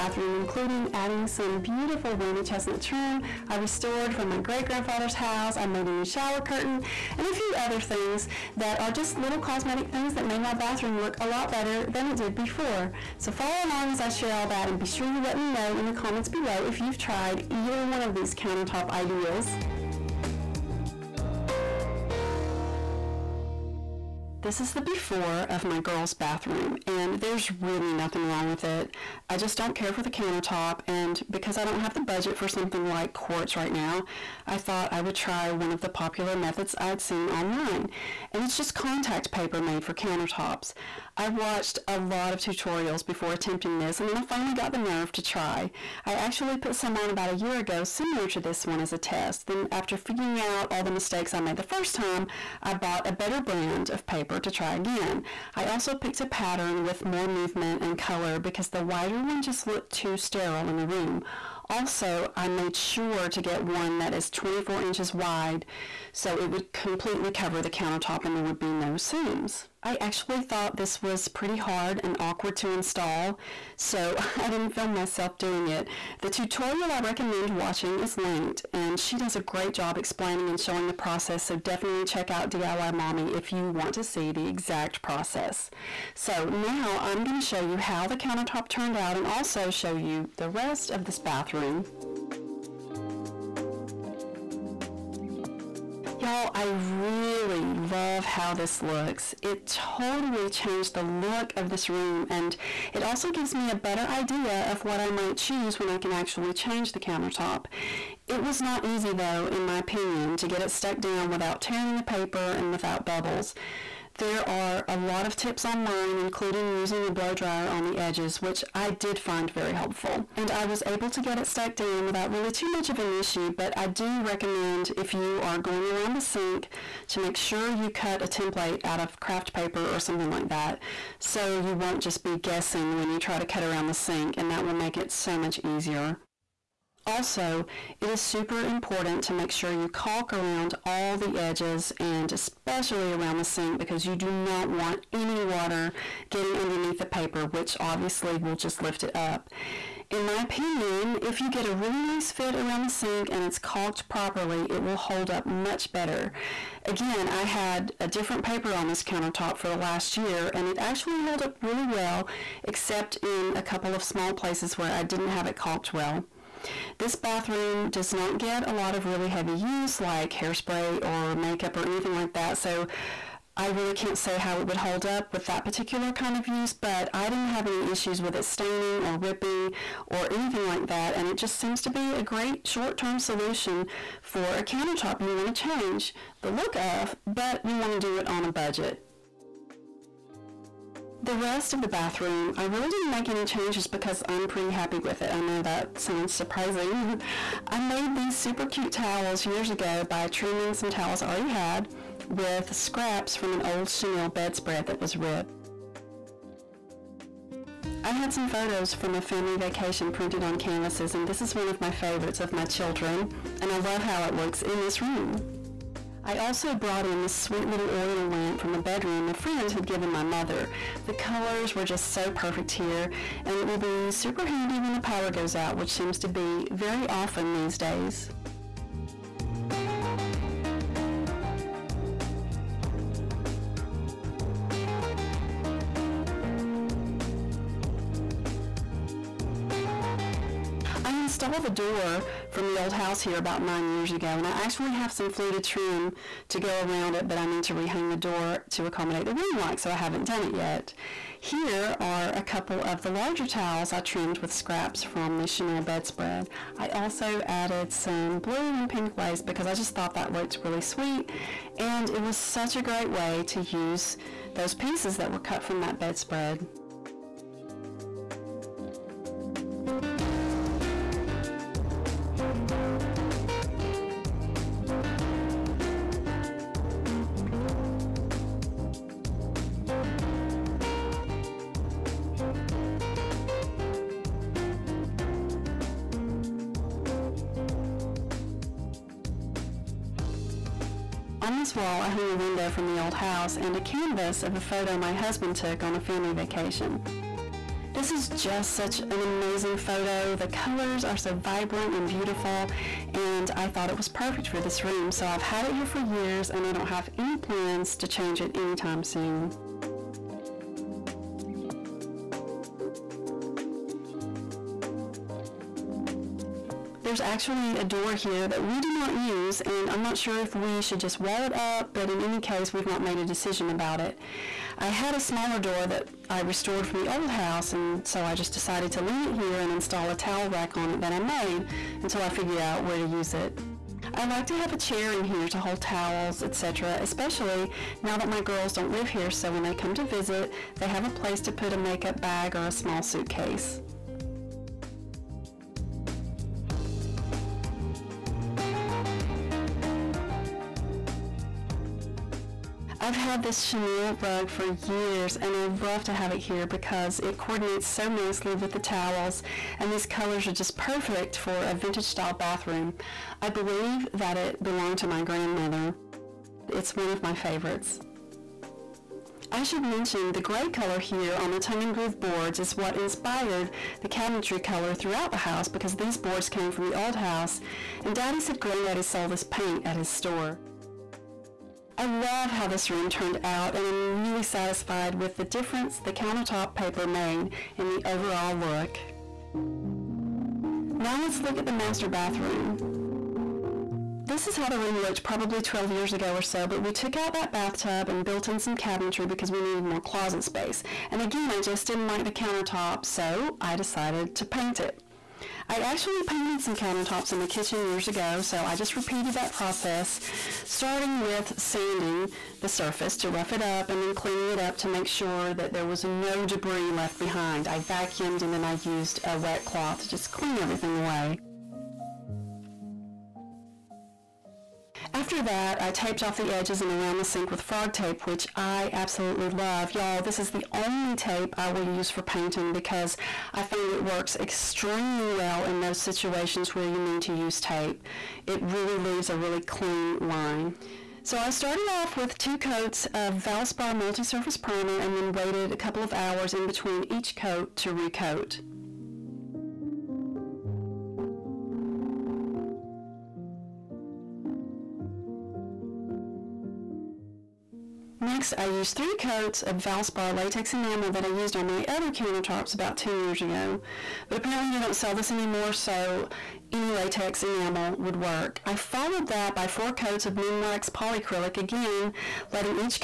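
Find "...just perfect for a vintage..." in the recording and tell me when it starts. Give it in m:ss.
6:00.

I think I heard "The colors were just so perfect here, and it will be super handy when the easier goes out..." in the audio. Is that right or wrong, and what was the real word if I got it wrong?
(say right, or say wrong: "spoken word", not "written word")
wrong: "power", not "easier".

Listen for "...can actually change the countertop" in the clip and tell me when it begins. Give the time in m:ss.
1:45.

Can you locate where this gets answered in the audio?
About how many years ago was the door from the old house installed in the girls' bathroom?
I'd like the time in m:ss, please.
4:03.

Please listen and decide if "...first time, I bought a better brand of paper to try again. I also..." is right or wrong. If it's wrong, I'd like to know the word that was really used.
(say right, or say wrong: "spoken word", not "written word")
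right.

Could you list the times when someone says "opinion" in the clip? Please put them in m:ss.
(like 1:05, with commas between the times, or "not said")
1:49, 2:30.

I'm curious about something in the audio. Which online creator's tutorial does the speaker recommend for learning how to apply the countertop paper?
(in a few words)
DIY Mommy.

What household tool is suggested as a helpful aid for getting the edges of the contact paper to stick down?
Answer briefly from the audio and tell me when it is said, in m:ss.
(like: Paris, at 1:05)
blow dryer, at 1:57.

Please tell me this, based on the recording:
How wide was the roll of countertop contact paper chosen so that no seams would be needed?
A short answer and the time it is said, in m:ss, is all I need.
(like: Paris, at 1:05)
24 inches, at 1:04.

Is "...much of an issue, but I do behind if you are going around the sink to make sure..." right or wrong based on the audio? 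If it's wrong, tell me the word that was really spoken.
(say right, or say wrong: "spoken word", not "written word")
wrong: "recommend", not "behind".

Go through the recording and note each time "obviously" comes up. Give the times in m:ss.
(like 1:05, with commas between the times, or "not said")
2:27.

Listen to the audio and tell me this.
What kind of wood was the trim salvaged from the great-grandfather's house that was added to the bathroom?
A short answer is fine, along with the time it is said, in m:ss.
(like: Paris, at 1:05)
wormy chestnut, at 0:02.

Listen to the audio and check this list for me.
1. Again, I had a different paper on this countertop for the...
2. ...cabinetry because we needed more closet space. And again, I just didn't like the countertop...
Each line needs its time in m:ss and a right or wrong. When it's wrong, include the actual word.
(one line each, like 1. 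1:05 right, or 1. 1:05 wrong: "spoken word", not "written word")
1. 2:36 right
2. 6:38 right.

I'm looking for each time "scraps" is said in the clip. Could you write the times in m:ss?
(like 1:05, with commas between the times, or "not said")
3:22, 4:14.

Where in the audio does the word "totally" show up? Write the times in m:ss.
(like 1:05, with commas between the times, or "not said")
1:39.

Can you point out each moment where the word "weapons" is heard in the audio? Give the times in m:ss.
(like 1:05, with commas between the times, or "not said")
not said.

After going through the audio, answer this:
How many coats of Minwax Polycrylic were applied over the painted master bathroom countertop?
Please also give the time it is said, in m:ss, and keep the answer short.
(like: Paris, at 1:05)
4, at 7:49.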